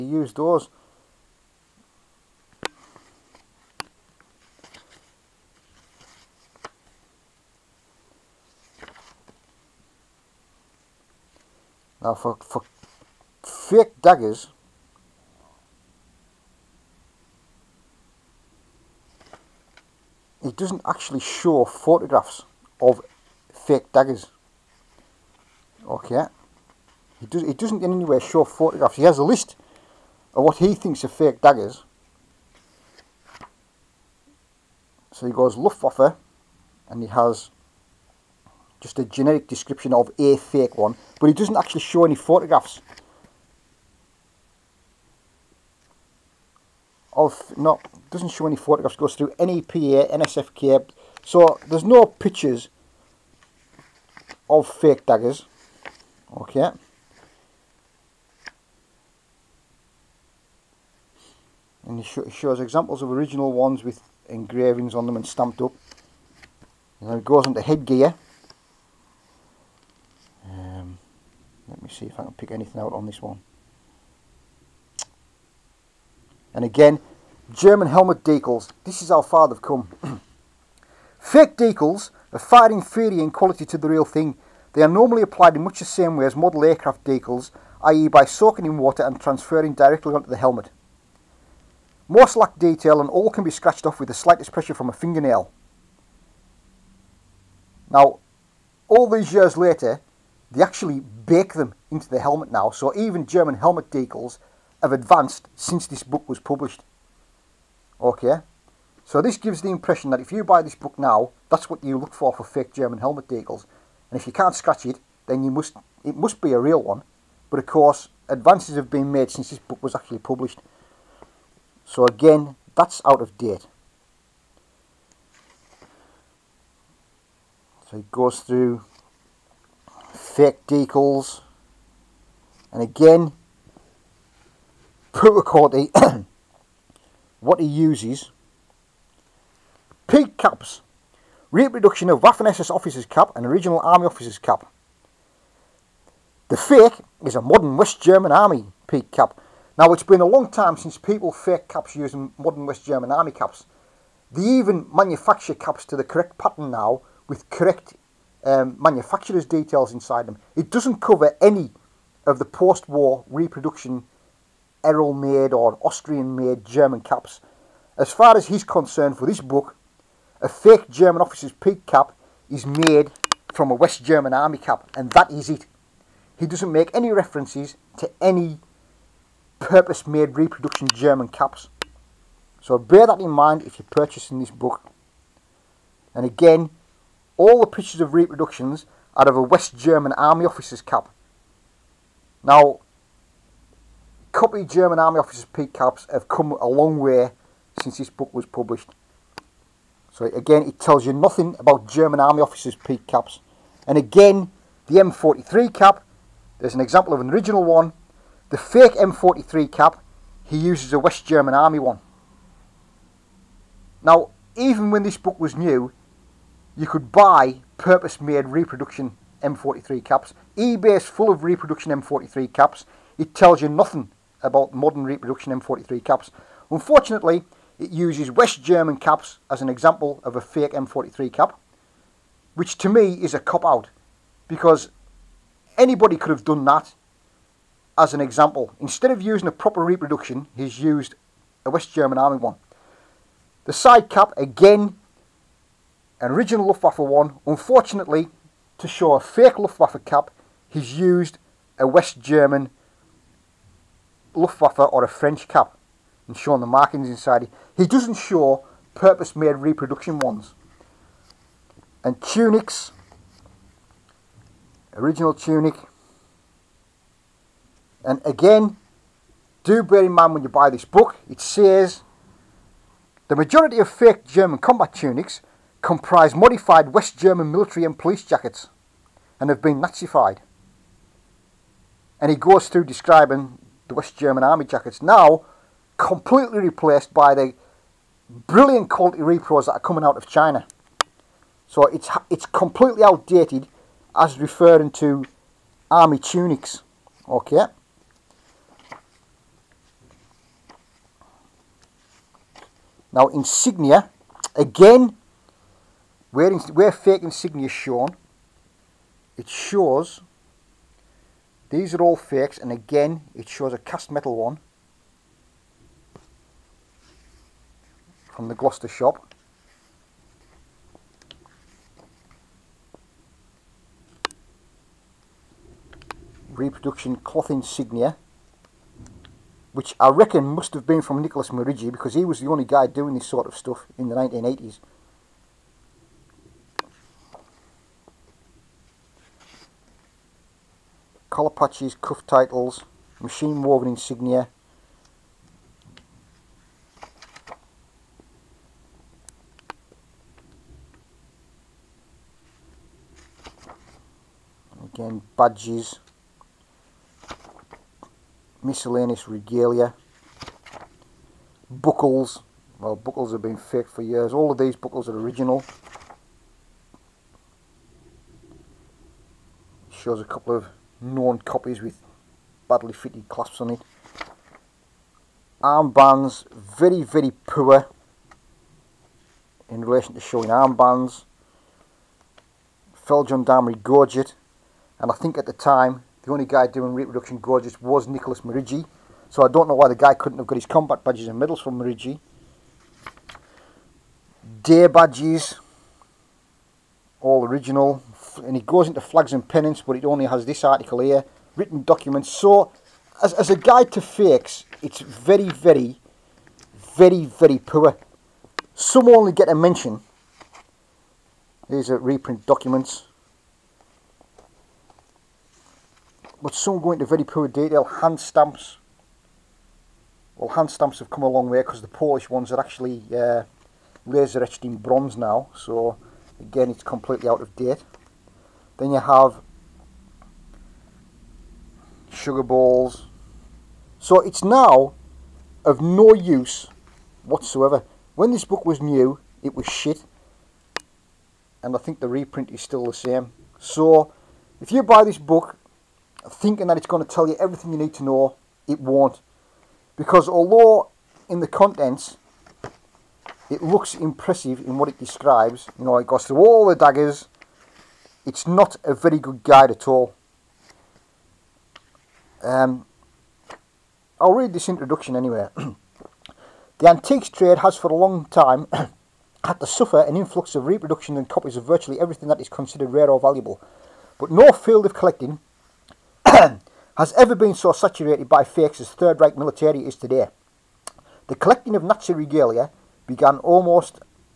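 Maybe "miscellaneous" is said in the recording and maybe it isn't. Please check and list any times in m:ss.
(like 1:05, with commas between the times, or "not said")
5:58.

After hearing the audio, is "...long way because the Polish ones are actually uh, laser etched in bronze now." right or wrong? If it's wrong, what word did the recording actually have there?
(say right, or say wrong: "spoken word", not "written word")
right.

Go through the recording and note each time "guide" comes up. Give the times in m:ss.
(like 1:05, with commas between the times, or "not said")
6:43, 7:39.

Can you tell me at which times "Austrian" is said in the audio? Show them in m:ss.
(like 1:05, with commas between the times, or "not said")
2:45.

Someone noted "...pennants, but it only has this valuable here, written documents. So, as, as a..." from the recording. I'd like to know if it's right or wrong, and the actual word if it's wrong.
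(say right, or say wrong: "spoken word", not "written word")
wrong: "article", not "valuable".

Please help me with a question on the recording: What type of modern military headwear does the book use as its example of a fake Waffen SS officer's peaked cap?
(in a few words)
West German army peak cap.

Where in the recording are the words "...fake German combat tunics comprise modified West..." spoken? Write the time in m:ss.
4:33.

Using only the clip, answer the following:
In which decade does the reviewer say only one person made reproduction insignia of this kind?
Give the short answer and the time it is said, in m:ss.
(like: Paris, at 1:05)
1980s, at 5:34.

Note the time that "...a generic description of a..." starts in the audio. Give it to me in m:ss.
0:38.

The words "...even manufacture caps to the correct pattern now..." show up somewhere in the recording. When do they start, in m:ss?
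2:34.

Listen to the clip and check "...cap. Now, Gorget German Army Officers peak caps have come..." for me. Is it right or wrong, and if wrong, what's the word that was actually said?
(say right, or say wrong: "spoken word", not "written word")
wrong: "Copy", not "Gorget".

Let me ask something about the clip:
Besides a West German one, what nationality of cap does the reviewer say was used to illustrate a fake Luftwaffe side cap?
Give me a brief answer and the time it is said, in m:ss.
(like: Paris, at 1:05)
French, at 4:15.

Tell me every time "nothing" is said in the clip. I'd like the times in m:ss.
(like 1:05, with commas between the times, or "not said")
3:21, 3:43.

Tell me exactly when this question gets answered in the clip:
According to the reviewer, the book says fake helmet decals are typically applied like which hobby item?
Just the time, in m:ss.
1:26.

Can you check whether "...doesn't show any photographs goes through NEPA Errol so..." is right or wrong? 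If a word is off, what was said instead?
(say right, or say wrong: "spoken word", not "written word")
wrong: "NSFK", not "Errol".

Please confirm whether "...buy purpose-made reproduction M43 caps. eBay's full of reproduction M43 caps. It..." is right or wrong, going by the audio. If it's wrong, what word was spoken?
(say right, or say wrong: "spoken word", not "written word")
right.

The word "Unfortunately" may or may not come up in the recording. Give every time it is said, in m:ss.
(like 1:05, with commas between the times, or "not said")
3:46, 4:07.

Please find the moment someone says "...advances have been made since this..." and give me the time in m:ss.
1:58.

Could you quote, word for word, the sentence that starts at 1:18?
This is how far they've come.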